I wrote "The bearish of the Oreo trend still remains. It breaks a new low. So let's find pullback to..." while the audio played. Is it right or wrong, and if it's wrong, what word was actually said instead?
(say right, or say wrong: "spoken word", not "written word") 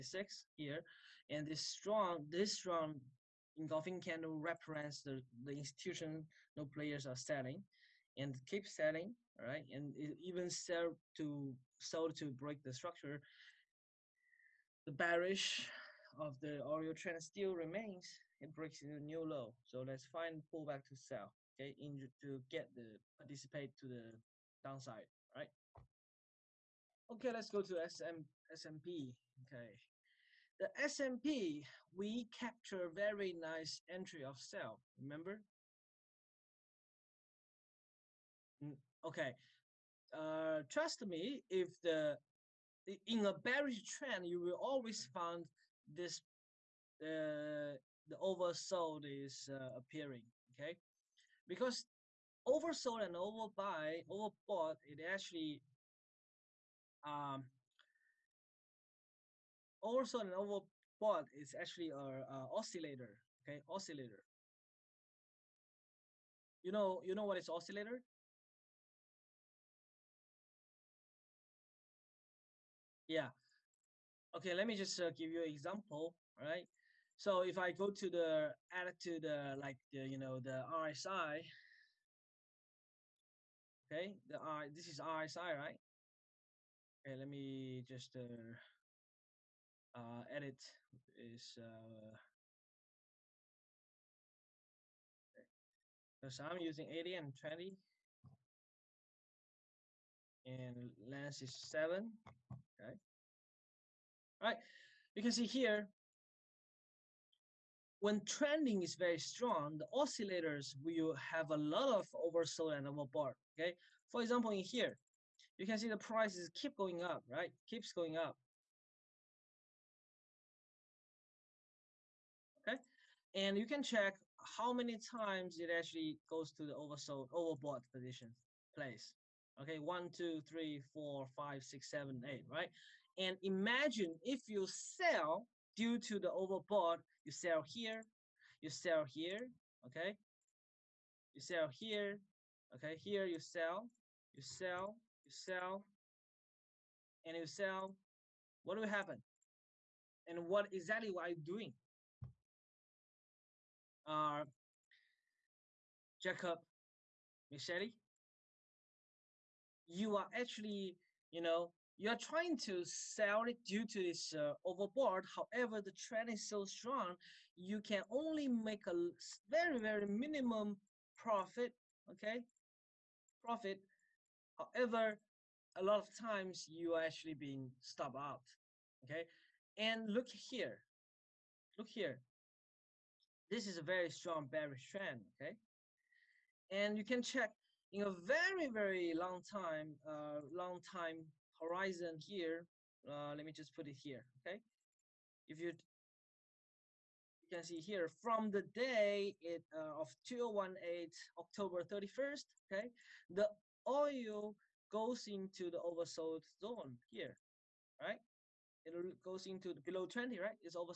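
right.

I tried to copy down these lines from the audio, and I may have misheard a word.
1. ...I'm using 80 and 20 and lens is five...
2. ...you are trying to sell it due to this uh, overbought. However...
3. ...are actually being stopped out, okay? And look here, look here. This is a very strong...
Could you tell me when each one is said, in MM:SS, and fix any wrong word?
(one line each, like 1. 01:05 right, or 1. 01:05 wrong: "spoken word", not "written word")
1. 01:36 wrong: "seven", not "five"
2. 02:41 right
3. 02:56 right.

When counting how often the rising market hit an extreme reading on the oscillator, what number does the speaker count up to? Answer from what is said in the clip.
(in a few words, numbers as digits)
8.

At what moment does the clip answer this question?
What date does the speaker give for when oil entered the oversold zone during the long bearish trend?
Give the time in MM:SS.
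03:20.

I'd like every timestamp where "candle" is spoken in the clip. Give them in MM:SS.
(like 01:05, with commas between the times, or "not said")
00:03.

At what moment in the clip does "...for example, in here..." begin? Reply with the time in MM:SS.
01:54.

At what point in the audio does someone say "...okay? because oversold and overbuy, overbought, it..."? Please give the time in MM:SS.
00:50.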